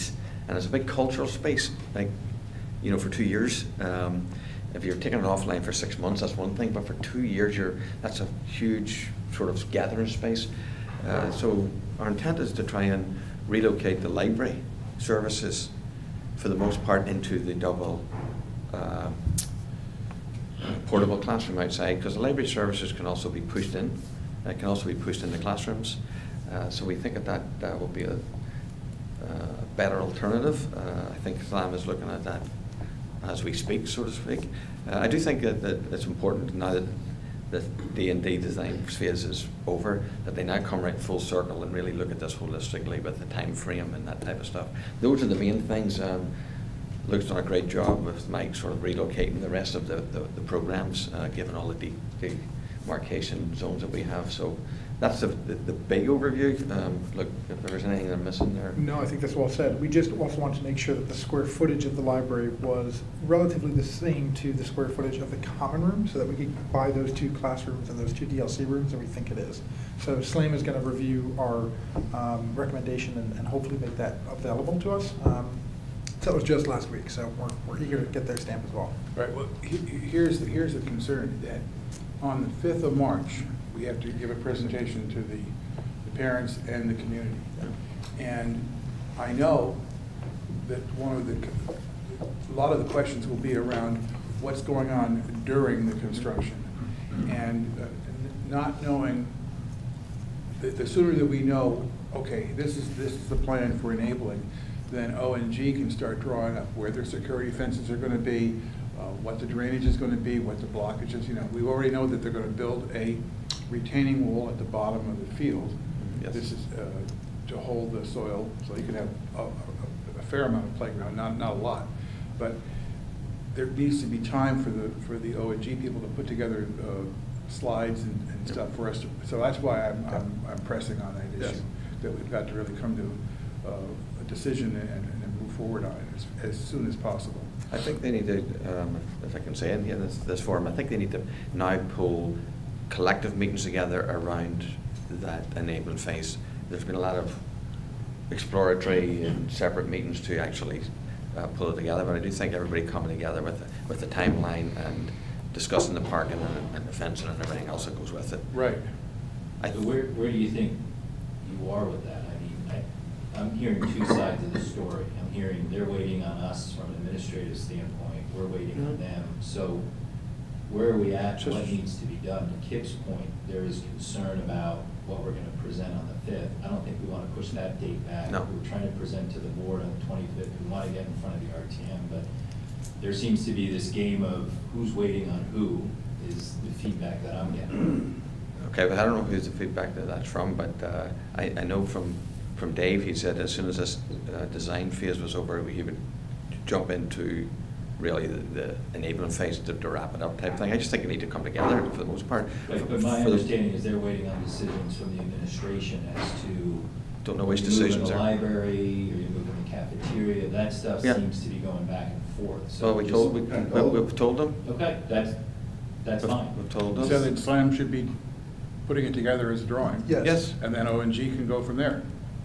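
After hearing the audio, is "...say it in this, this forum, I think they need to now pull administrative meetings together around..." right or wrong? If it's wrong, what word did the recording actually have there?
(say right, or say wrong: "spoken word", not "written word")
wrong: "collective", not "administrative".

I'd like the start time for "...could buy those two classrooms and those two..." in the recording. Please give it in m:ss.
1:06.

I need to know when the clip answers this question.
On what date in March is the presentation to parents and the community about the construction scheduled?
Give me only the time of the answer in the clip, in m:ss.
1:22.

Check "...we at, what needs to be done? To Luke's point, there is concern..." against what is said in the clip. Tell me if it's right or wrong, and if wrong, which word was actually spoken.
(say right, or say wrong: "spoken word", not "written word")
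wrong: "Kip", not "Luke".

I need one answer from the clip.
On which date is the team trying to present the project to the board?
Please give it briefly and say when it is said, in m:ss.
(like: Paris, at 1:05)
the 25th, at 3:00.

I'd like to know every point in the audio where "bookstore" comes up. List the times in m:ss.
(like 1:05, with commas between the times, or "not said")
not said.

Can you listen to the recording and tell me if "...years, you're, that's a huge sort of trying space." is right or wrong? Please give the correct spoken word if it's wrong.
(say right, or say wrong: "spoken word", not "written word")
wrong: "gathering", not "trying".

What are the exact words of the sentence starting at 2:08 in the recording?
stuff for us to, so that's why I'm, yep.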